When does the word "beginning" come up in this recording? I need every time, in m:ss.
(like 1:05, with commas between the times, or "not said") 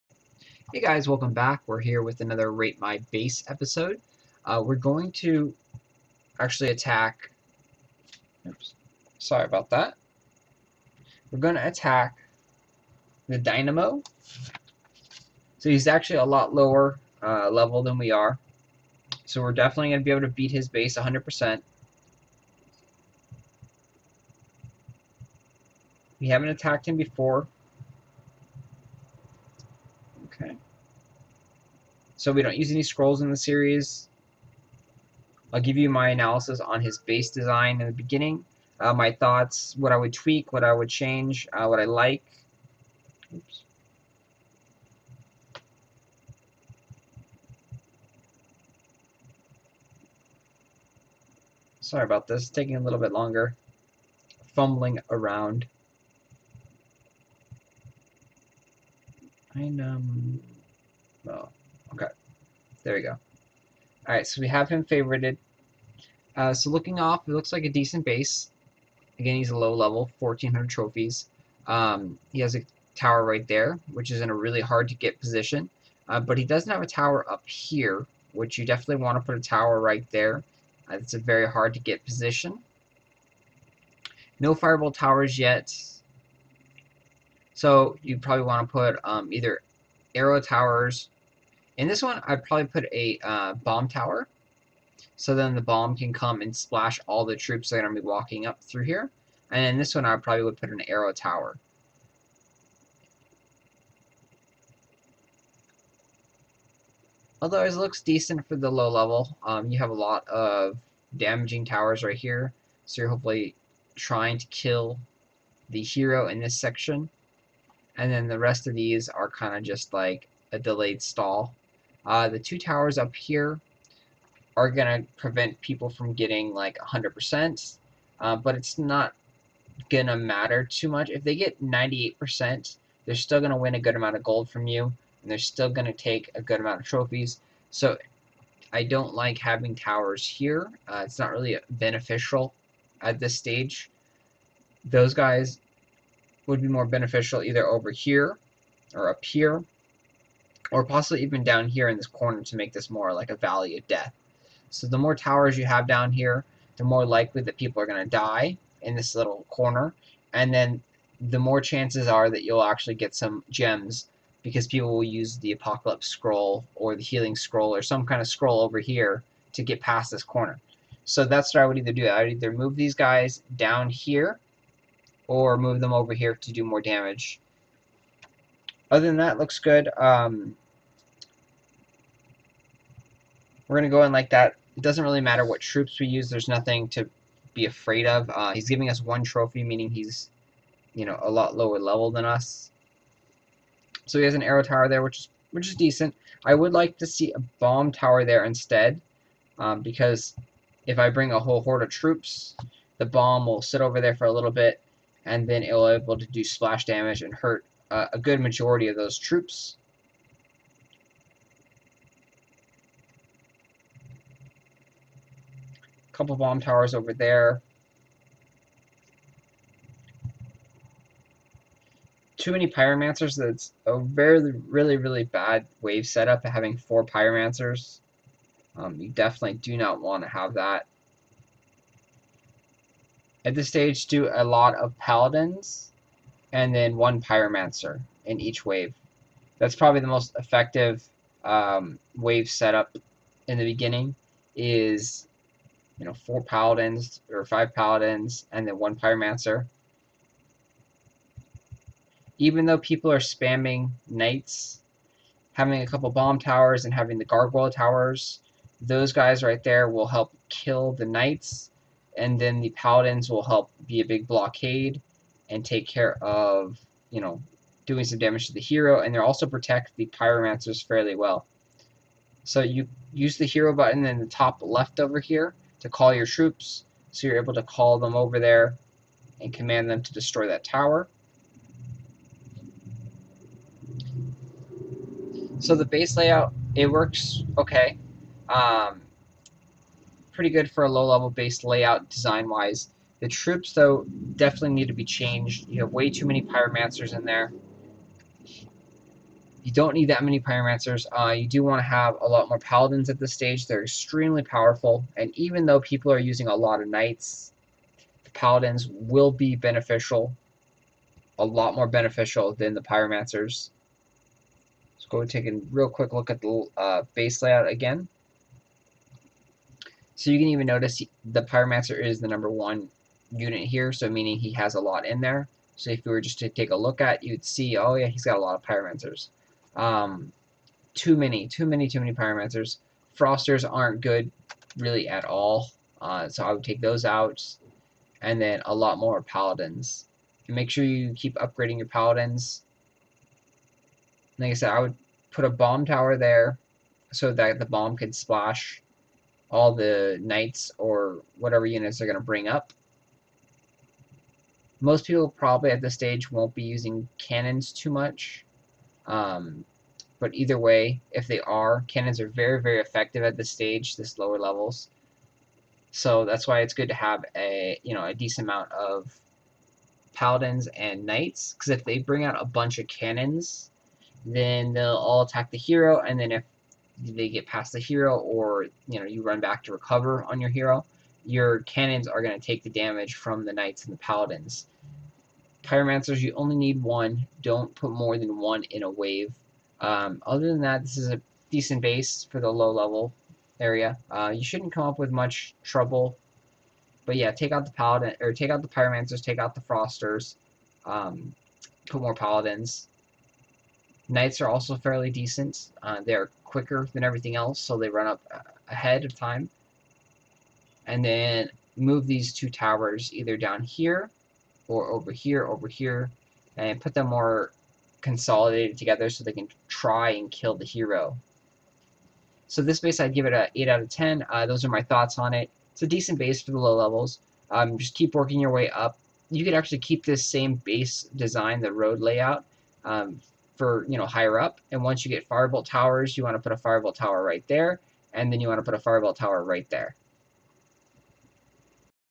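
0:37, 4:03.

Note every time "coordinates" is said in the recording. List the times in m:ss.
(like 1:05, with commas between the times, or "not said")
not said.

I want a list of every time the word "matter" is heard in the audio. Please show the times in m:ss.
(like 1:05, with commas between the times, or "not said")
2:10, 3:05.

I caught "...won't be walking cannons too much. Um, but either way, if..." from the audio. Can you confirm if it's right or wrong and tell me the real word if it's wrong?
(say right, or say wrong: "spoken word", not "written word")
wrong: "using", not "walking".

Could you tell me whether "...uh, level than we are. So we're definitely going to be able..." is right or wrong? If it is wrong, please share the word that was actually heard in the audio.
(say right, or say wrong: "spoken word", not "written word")
right.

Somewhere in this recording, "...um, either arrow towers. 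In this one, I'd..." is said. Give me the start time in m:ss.
1:29.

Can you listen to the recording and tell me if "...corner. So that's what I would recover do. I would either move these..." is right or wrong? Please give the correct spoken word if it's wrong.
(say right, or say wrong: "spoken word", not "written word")
wrong: "either", not "recover".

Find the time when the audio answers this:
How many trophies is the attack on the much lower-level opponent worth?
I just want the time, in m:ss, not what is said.
3:09.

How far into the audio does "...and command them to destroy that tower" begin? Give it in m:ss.
4:39.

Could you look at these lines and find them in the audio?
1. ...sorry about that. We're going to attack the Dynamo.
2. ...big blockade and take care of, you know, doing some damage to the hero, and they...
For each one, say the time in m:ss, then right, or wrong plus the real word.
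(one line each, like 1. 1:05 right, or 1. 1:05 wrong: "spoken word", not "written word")
1. 0:09 right
2. 4:24 right.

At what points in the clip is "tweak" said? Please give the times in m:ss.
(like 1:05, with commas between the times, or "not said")
0:40.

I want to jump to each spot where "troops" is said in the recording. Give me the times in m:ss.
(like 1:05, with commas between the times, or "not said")
1:37, 3:05, 3:21, 3:29, 4:36, 4:53.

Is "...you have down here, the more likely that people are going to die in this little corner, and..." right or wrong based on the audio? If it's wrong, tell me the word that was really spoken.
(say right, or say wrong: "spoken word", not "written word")
right.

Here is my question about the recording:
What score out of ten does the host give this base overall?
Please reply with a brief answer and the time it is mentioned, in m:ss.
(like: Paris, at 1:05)
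8, at 7:03.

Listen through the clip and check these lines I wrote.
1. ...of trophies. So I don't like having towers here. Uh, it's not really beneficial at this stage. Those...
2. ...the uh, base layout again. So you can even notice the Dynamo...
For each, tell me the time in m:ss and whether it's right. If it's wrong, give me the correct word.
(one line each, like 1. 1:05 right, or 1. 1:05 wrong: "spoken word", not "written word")
1. 2:16 right
2. 5:16 wrong: "Pyromancer", not "Dynamo".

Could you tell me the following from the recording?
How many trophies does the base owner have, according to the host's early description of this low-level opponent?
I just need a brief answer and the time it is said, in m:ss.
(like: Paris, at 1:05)
1,400, at 1:10.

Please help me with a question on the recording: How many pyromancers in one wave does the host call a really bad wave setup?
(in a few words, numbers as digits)
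4.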